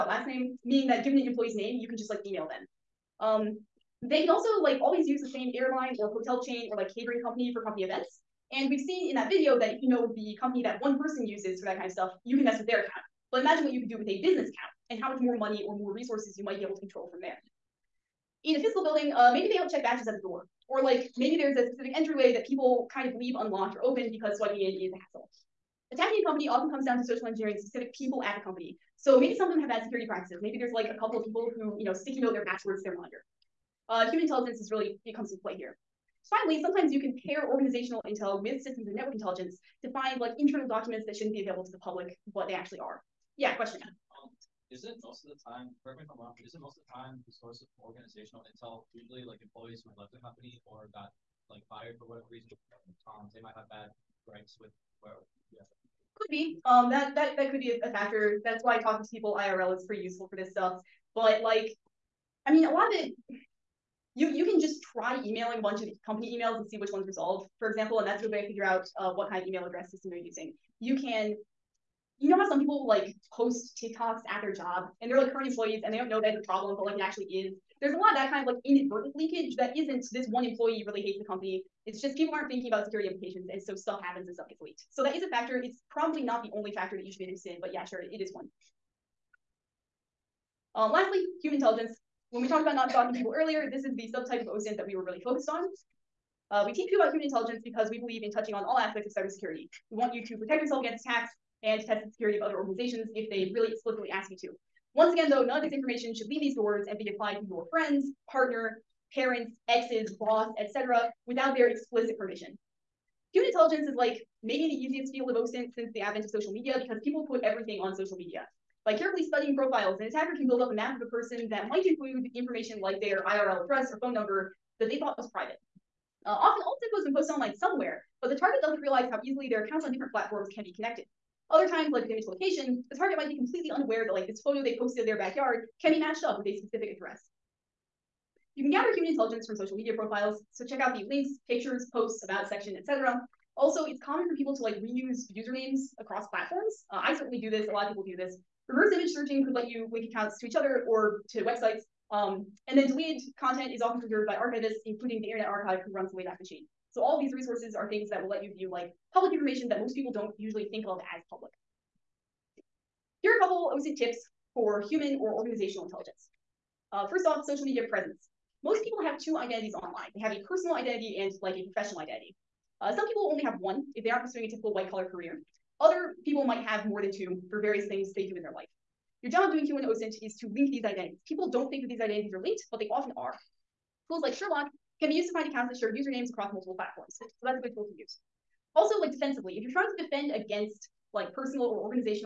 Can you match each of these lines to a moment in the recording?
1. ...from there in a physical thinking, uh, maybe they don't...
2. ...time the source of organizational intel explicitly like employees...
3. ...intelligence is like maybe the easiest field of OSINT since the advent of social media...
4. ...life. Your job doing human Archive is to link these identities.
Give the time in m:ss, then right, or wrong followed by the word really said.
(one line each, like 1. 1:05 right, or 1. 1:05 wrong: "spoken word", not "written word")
1. 0:17 wrong: "building", not "thinking"
2. 0:46 wrong: "usually", not "explicitly"
3. 1:53 right
4. 2:58 wrong: "OSINT", not "Archive".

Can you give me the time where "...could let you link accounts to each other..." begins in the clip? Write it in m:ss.
2:29.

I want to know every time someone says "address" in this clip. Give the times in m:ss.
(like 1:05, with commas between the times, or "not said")
1:09, 2:03, 2:16.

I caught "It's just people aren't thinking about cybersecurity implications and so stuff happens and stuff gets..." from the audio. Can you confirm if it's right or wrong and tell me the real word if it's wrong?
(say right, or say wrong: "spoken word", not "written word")
wrong: "security", not "cybersecurity".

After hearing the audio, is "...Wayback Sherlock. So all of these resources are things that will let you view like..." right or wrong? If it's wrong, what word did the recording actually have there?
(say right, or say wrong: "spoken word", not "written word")
wrong: "Machine", not "Sherlock".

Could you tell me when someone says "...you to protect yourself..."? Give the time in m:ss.
1:40.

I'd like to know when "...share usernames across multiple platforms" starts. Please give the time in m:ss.
3:05.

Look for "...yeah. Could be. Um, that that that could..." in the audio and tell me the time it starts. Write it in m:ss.
0:55.